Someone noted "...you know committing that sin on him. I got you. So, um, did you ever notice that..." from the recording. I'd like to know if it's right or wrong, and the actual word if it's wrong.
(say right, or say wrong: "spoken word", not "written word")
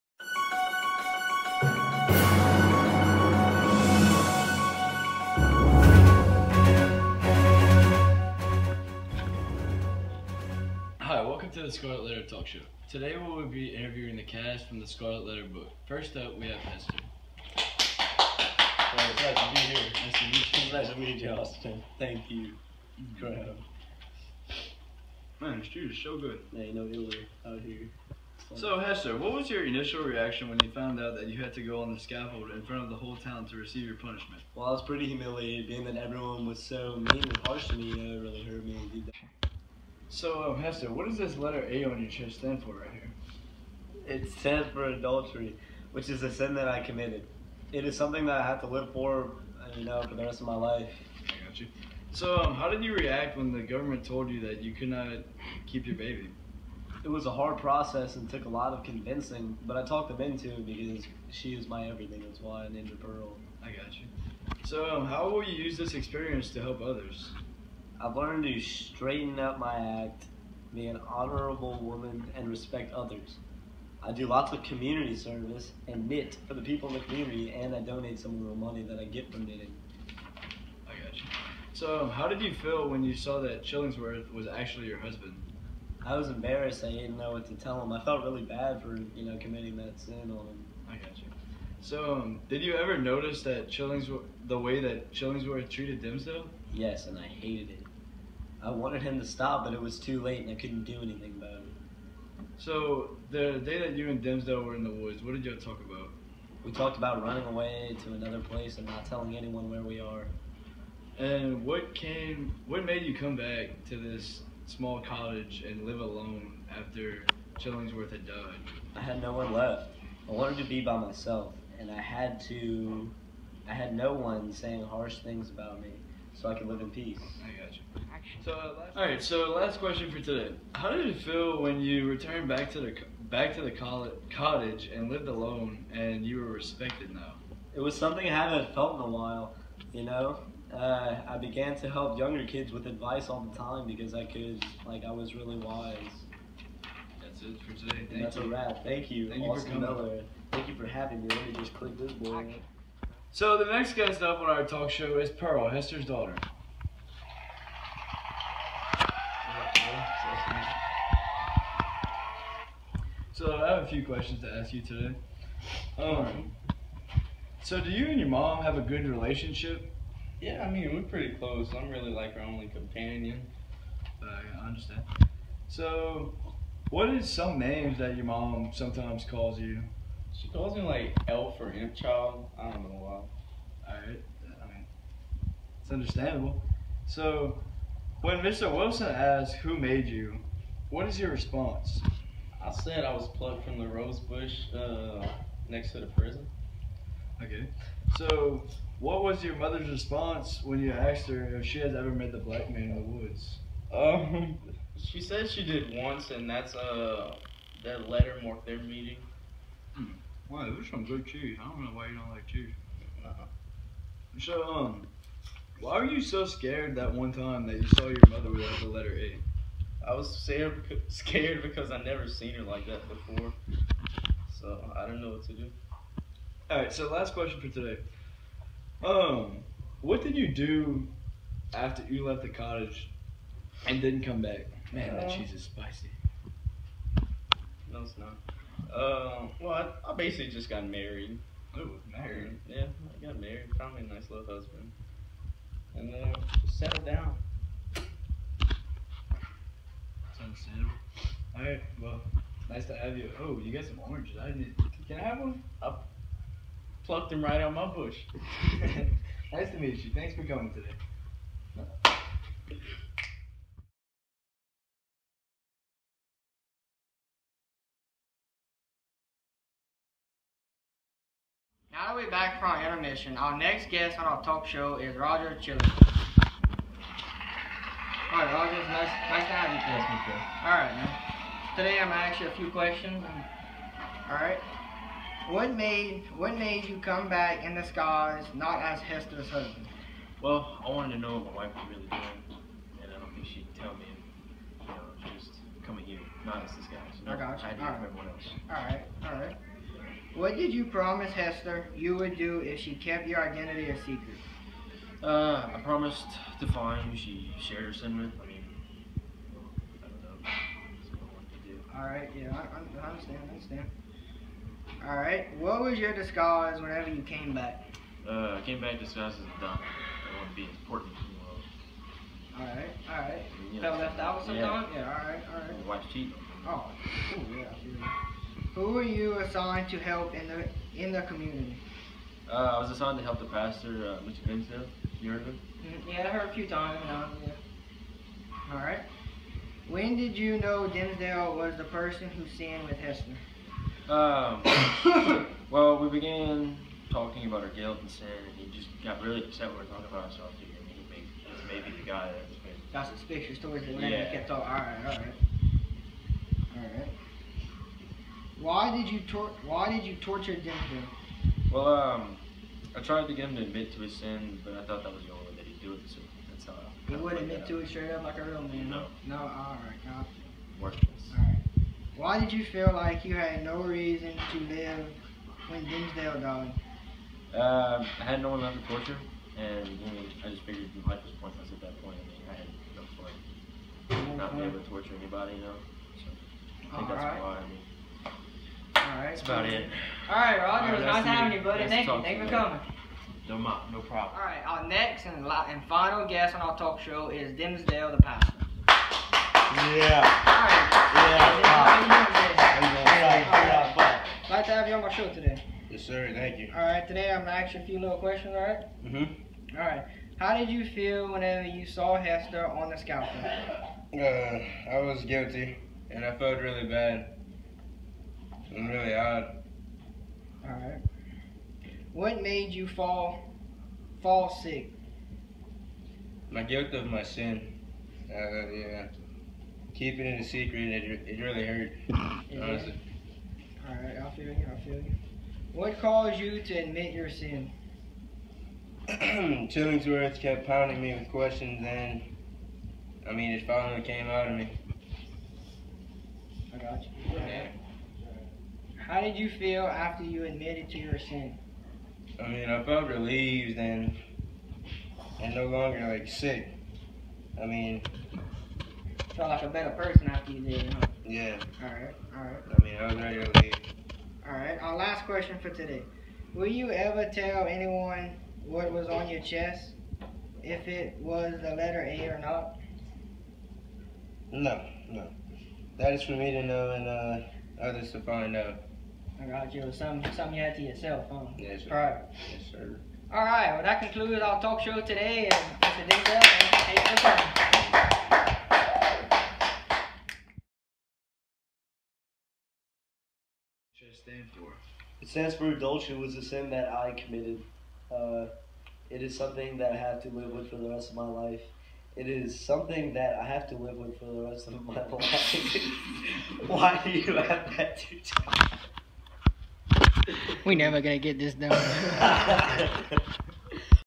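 right.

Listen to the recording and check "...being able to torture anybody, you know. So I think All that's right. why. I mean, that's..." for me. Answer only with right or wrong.
right.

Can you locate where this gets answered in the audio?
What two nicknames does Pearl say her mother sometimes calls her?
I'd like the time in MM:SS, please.
03:01.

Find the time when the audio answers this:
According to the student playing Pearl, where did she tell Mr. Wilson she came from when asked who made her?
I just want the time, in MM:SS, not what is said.
03:13.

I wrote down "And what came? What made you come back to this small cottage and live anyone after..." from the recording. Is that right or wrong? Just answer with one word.
wrong.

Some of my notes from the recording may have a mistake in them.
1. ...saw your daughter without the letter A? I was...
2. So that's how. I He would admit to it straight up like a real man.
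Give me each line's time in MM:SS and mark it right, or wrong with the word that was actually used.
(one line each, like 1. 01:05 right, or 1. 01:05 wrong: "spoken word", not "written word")
1. 03:37 wrong: "mother", not "daughter"
2. 06:06 right.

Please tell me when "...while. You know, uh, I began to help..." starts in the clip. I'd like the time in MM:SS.
02:19.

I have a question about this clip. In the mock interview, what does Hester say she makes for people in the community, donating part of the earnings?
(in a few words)
Knitting.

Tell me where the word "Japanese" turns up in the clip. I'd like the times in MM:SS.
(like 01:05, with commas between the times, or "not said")
not said.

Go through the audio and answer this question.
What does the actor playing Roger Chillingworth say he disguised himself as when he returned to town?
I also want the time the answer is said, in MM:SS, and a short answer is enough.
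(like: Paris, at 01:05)
A dog, at 05:19.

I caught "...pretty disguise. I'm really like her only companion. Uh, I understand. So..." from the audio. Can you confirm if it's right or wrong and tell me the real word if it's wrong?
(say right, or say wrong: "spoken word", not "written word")
wrong: "close", not "disguise".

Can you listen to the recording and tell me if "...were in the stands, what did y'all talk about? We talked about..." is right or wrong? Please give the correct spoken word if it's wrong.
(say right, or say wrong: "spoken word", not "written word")
wrong: "woods", not "stands".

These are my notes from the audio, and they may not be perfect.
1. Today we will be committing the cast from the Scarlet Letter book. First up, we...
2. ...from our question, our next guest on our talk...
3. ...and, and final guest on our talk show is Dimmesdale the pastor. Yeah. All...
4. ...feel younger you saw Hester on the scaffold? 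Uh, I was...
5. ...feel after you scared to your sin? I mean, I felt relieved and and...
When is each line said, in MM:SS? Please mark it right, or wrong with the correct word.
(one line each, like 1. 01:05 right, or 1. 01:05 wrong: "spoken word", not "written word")
1. 00:12 wrong: "interviewing", not "committing"
2. 04:32 wrong: "intermission", not "question"
3. 06:35 right
4. 06:50 wrong: "whenever", not "younger"
5. 07:29 wrong: "admitted", not "scared".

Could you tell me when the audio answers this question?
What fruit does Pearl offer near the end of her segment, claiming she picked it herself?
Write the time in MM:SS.
04:14.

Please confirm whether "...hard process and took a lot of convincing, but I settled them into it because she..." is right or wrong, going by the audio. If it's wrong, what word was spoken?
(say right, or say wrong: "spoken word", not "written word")
wrong: "talked", not "settled".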